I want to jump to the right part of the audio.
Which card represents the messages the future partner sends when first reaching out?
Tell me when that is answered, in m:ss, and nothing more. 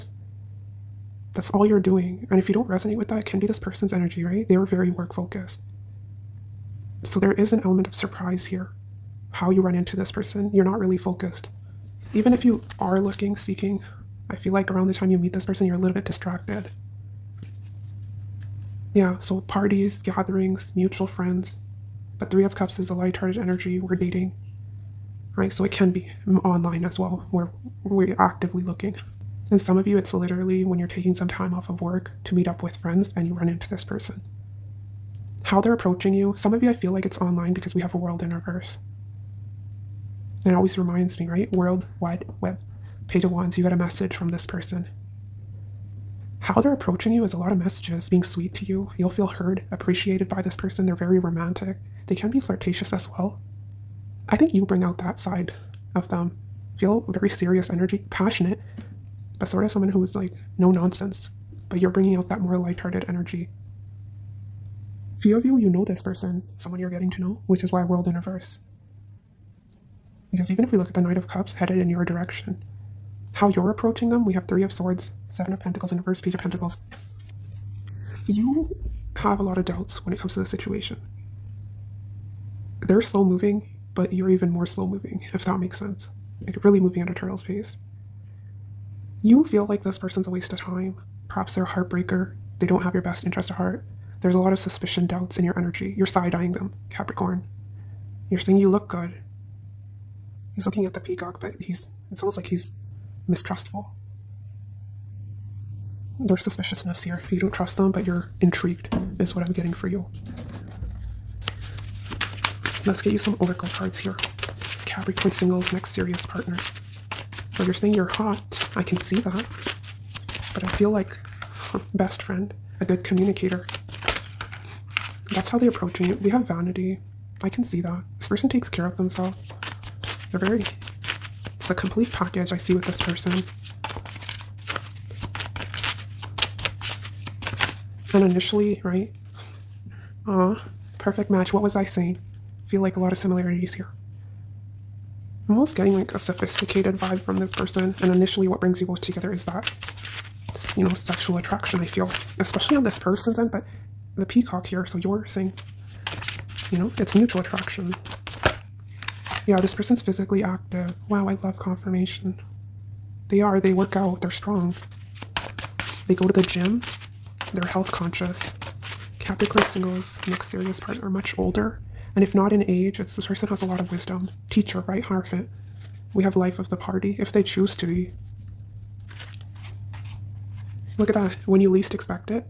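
0:43.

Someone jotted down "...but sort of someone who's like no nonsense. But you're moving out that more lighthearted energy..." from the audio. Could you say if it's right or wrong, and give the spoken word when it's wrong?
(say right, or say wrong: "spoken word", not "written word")
wrong: "bringing", not "moving".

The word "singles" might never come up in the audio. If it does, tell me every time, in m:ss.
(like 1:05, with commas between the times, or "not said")
1:55, 2:49.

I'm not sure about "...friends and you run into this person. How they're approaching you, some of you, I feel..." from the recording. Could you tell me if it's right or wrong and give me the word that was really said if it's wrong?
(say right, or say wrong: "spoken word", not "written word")
right.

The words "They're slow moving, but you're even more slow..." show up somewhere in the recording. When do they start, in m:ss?
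1:22.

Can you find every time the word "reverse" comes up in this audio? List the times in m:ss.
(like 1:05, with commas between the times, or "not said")
0:38, 1:08, 1:15.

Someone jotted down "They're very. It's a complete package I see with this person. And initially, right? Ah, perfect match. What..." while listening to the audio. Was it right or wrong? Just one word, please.
right.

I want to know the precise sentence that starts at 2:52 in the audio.
And if not in age, it's this person has a lot of wisdom.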